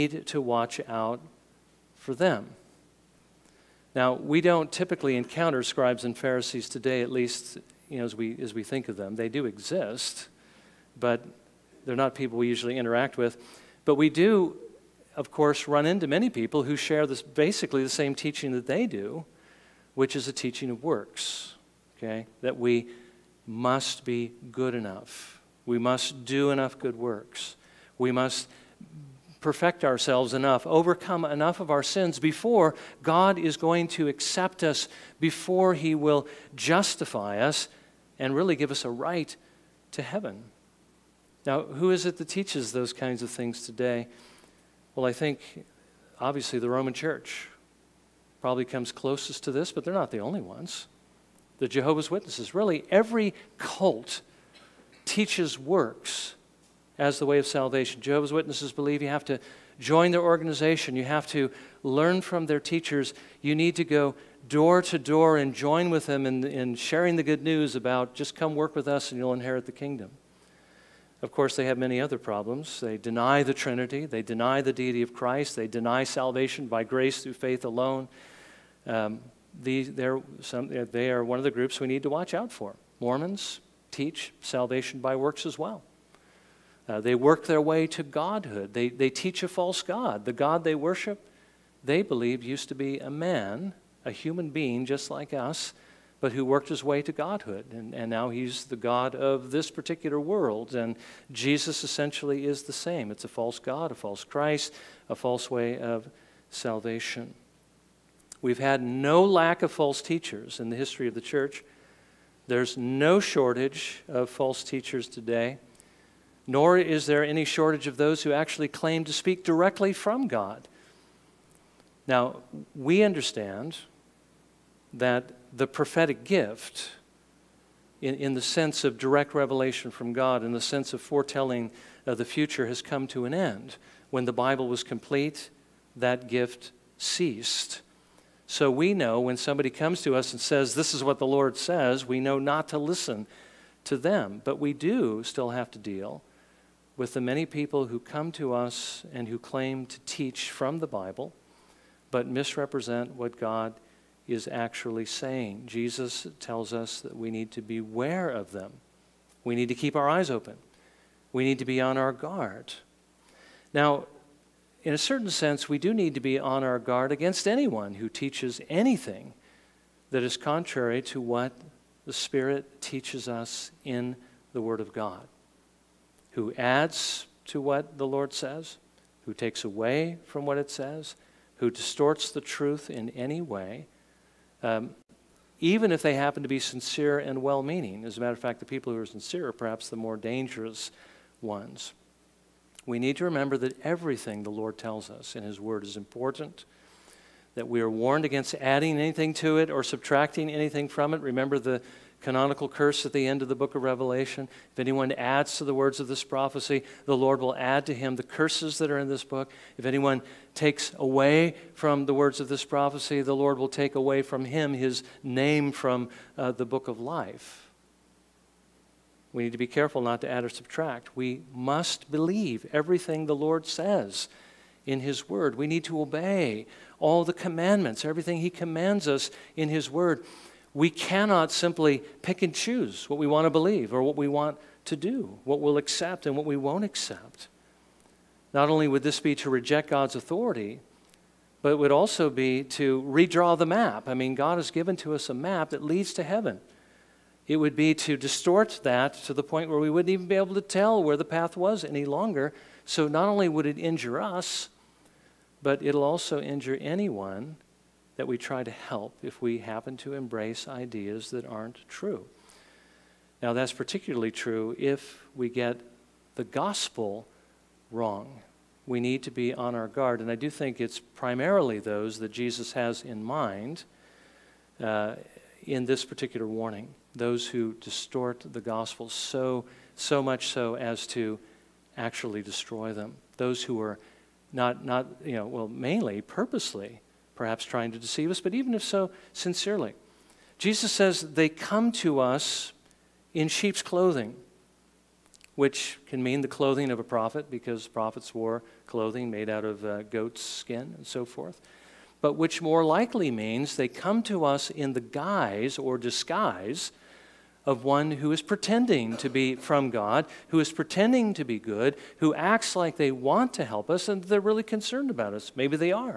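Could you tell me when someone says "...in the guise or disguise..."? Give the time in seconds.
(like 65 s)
304 s.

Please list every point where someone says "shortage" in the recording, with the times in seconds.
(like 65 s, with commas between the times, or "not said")
113 s, 117 s.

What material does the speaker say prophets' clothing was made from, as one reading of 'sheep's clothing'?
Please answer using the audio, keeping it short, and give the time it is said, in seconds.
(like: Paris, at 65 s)
Goat's skin, at 300 s.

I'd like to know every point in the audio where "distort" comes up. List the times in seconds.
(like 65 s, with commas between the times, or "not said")
181 s, 248 s, 277 s.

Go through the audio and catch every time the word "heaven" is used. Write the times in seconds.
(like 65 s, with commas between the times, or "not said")
40 s, 246 s.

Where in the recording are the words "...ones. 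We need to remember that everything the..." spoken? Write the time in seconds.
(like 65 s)
191 s.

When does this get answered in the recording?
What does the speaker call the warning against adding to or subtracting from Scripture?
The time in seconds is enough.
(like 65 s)
202 s.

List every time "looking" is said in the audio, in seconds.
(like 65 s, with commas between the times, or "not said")
not said.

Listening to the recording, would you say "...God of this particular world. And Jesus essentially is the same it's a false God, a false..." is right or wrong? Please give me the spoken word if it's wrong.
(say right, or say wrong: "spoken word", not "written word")
right.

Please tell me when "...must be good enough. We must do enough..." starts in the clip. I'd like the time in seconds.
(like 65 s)
23 s.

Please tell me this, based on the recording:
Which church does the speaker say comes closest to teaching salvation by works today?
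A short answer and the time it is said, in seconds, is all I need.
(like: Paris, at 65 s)
The Roman Church, at 46 s.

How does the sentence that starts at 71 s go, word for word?
Of course, they have many other problems.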